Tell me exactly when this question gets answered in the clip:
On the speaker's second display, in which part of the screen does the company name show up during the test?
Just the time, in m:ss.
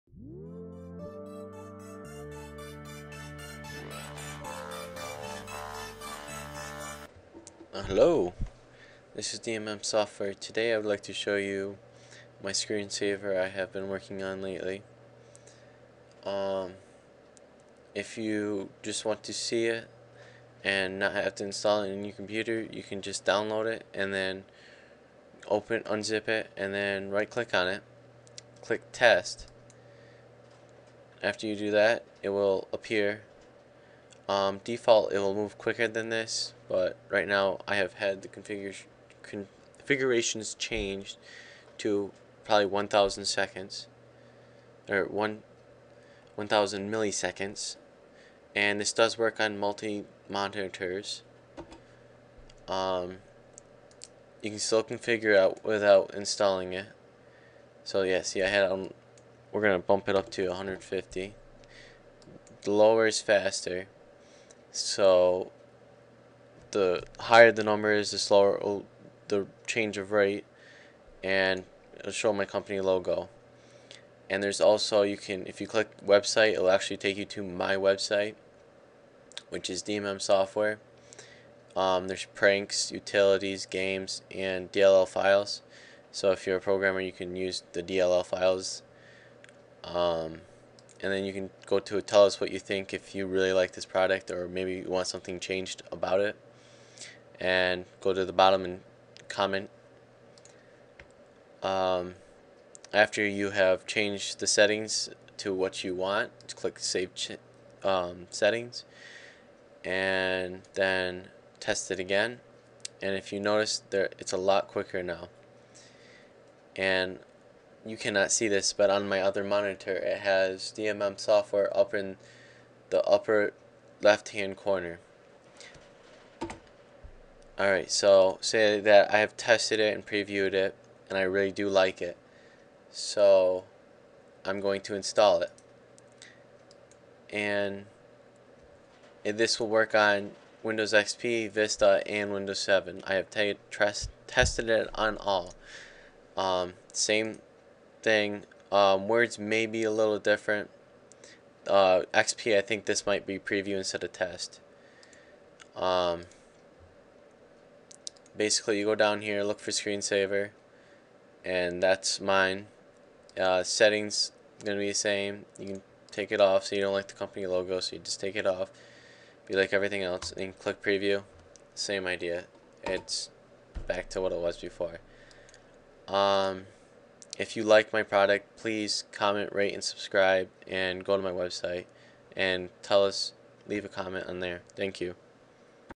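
2:03.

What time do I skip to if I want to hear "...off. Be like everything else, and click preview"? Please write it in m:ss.
2:48.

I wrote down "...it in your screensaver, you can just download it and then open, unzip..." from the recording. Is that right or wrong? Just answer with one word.
wrong.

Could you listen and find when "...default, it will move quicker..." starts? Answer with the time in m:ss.
0:34.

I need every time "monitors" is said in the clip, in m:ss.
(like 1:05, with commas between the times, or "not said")
0:50, 1:59.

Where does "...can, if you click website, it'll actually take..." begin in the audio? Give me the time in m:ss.
1:15.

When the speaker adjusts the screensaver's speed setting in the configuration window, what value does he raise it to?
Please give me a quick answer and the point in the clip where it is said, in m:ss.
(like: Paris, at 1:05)
150, at 1:00.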